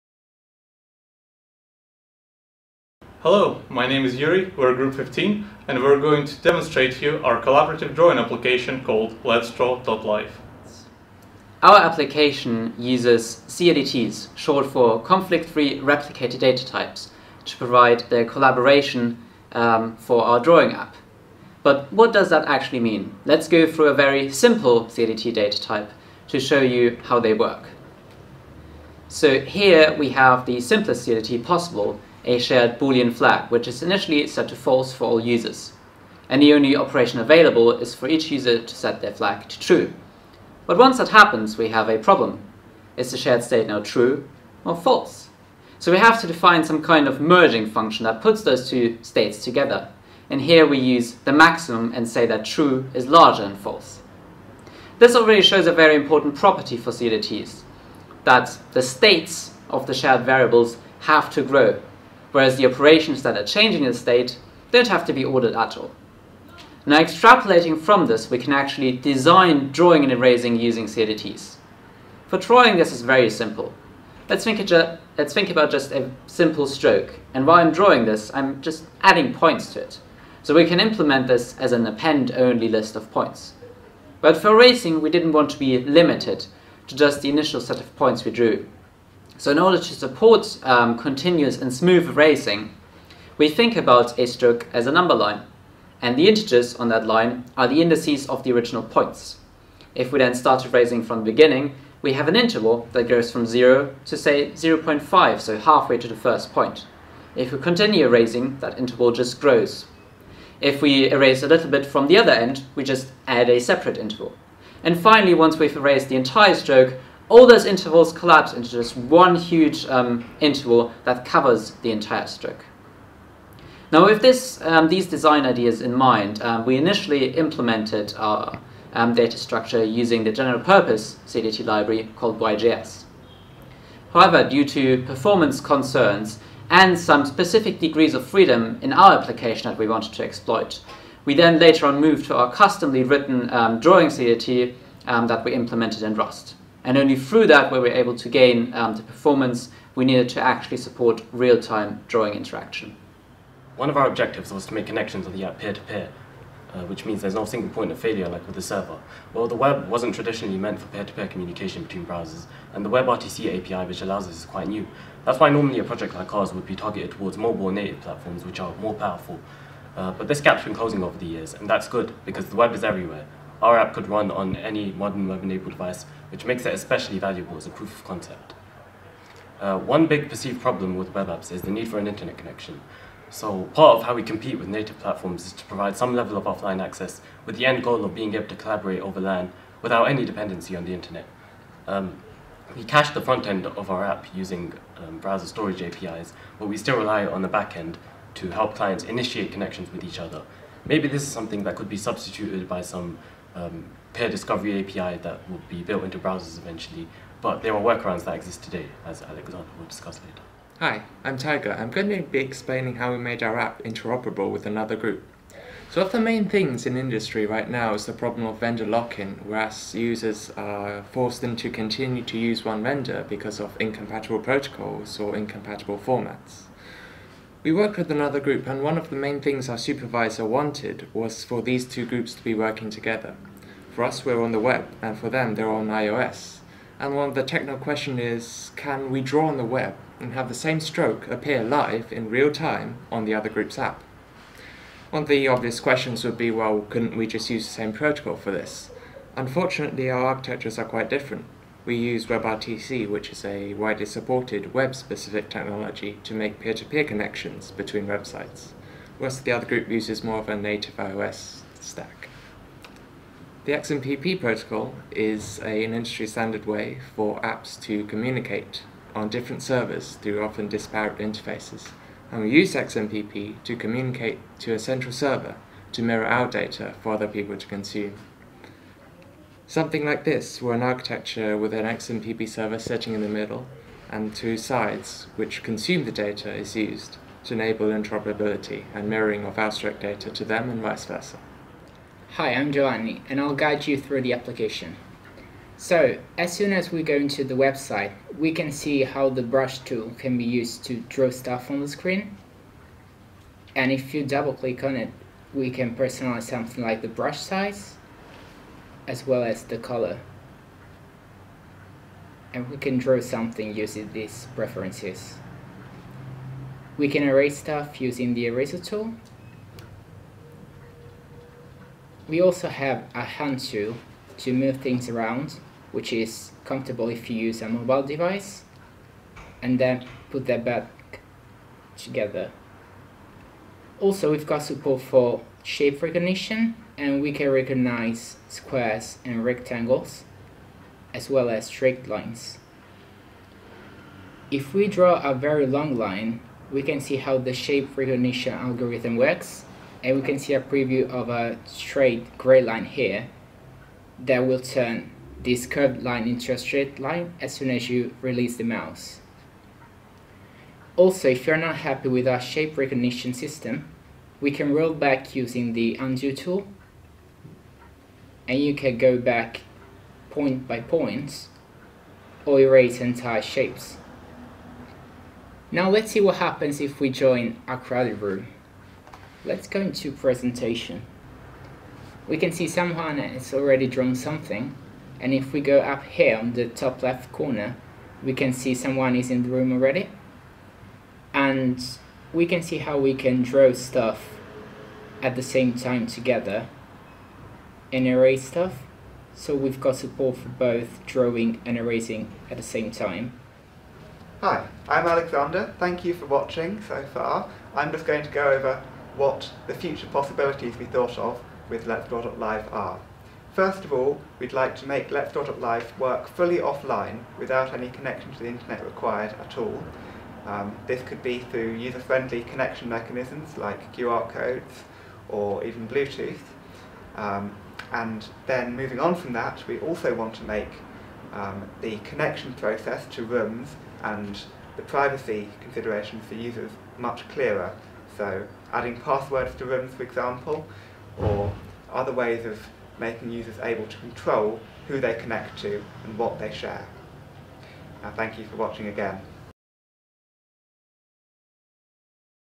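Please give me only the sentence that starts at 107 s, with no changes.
If we continue erasing, that interval just grows.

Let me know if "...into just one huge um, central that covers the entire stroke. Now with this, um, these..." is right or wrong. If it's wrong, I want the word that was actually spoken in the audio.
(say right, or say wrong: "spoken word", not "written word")
wrong: "interval", not "central".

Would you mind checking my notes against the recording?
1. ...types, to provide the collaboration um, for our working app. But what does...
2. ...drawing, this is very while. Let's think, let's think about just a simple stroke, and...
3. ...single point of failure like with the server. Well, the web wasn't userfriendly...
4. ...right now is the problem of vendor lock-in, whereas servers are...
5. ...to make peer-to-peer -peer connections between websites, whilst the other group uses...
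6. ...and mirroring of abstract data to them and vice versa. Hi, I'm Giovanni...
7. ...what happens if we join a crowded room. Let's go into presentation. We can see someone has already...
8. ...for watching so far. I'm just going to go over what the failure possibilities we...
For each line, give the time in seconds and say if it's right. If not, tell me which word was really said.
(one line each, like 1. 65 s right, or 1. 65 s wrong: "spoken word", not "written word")
1. 16 s wrong: "drawing", not "working"
2. 72 s wrong: "simple", not "while"
3. 157 s wrong: "traditionally", not "userfriendly"
4. 217 s wrong: "users", not "servers"
5. 256 s right
6. 288 s right
7. 376 s right
8. 406 s wrong: "future", not "failure".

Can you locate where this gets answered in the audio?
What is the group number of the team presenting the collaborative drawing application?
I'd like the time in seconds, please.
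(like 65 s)
4 s.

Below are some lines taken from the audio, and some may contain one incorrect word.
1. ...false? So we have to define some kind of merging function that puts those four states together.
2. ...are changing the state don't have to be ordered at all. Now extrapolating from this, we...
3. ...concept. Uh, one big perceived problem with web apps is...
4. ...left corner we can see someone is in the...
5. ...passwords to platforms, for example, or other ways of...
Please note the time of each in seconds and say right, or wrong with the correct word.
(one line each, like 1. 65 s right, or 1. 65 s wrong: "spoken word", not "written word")
1. 44 s wrong: "two", not "four"
2. 63 s right
3. 178 s right
4. 387 s right
5. 439 s wrong: "rooms", not "platforms".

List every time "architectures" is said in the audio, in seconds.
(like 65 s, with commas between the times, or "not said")
250 s, 280 s.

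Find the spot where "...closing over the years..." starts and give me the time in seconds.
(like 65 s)
170 s.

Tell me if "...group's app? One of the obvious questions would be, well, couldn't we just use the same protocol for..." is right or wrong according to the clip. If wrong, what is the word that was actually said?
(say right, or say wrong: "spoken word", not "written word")
right.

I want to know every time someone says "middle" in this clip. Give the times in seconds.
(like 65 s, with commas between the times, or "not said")
283 s.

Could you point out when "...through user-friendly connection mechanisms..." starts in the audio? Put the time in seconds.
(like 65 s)
421 s.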